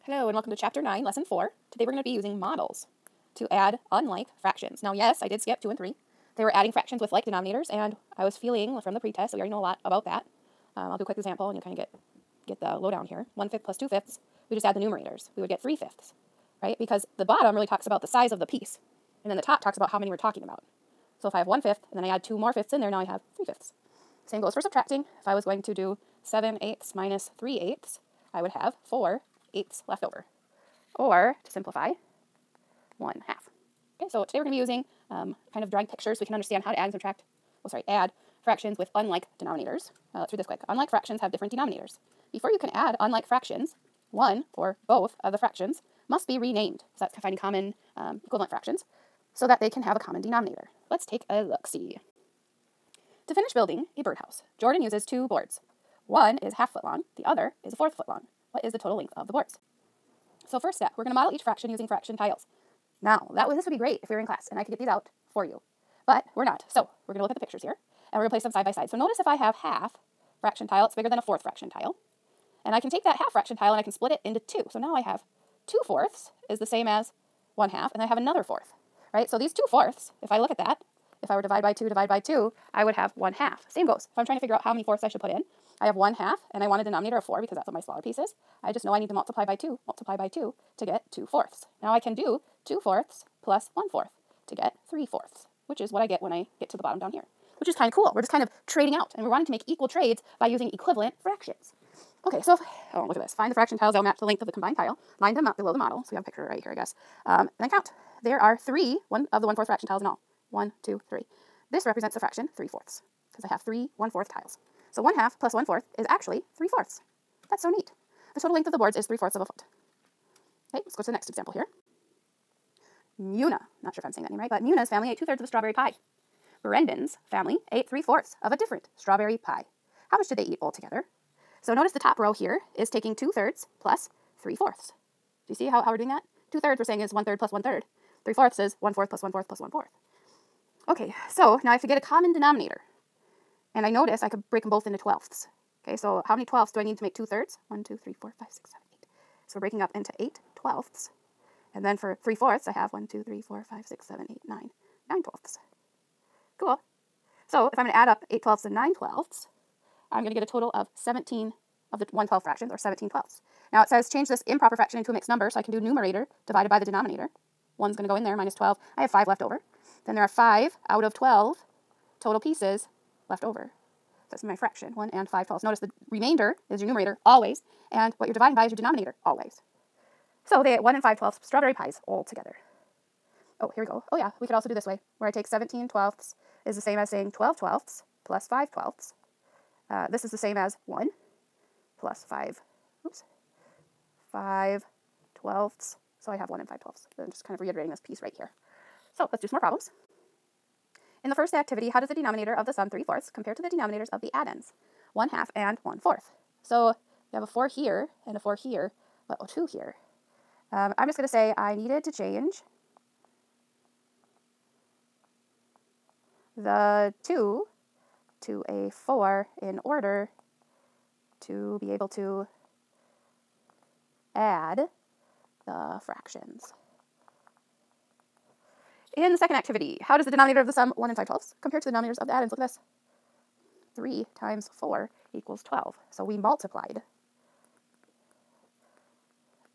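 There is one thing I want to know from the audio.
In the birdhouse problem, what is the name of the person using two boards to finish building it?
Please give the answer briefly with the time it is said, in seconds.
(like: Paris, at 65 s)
Jordan, at 54 s.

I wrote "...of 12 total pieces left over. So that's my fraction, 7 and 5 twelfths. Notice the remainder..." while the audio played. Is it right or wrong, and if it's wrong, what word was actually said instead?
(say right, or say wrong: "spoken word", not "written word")
wrong: "1", not "7".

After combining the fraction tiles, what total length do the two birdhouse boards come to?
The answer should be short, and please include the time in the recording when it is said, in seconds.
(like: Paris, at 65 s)
3/4 of a foot, at 119 s.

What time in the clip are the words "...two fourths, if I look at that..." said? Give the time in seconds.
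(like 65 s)
79 s.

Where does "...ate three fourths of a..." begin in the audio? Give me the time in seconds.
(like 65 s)
127 s.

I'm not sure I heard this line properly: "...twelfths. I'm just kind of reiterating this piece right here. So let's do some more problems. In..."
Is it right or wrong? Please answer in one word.
right.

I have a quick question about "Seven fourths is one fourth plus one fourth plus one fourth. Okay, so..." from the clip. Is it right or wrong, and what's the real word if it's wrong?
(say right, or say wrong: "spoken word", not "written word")
wrong: "Three", not "Seven".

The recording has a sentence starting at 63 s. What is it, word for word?
Now, that this would be great if we were in class and I could get these out for you.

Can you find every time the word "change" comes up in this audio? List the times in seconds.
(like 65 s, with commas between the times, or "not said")
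164 s, 212 s.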